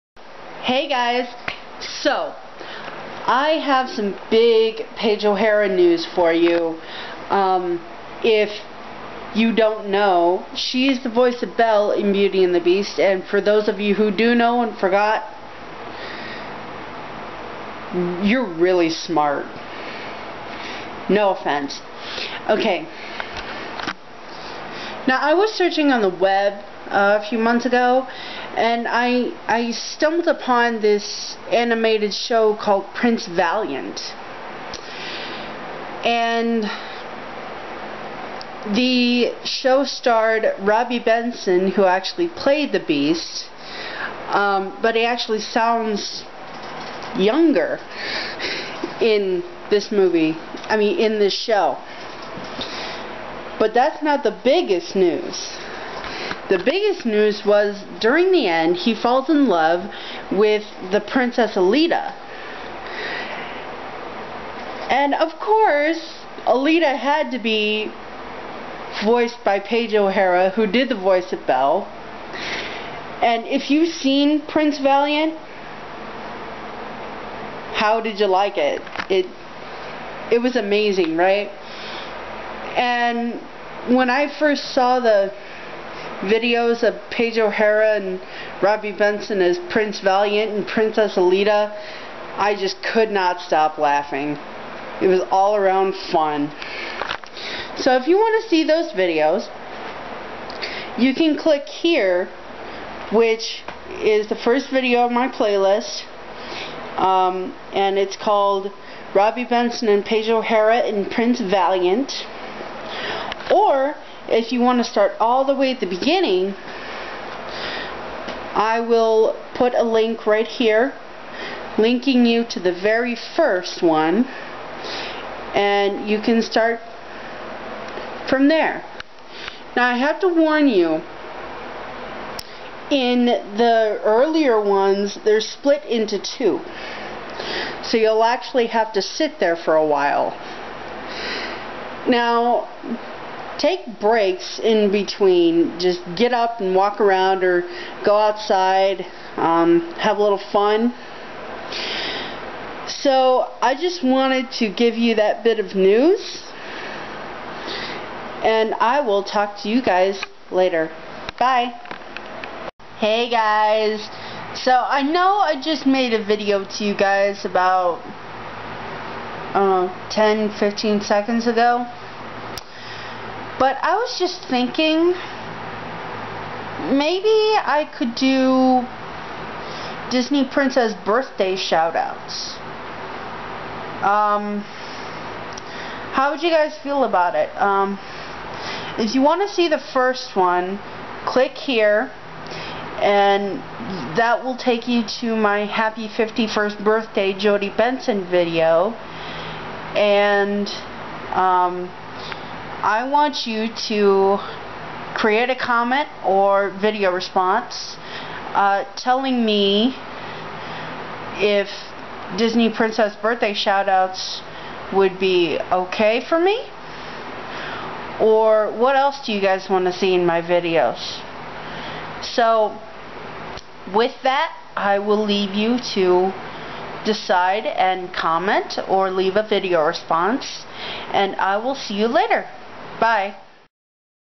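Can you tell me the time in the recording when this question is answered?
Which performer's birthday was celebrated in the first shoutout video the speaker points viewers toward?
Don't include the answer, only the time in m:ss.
3:17.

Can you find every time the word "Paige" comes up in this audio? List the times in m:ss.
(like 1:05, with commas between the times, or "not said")
0:04, 1:09, 1:27, 1:50.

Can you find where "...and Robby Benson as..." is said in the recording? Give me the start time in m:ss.
1:27.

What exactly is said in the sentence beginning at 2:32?
So I just wanted to give you that bit of news.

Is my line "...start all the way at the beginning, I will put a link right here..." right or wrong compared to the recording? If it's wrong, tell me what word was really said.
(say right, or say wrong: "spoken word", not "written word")
right.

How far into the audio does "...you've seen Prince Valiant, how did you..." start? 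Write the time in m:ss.
1:13.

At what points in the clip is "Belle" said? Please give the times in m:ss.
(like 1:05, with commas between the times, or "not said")
0:11, 1:11.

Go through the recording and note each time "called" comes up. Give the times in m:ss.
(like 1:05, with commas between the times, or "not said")
0:32, 1:48.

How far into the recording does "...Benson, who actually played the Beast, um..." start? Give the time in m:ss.
0:40.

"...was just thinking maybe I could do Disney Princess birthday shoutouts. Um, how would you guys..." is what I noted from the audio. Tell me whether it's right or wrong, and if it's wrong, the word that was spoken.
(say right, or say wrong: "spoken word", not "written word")
right.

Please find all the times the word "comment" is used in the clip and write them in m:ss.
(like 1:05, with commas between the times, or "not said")
3:25, 3:48.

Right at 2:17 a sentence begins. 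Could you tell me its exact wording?
So you'll actually have to sit there for a while.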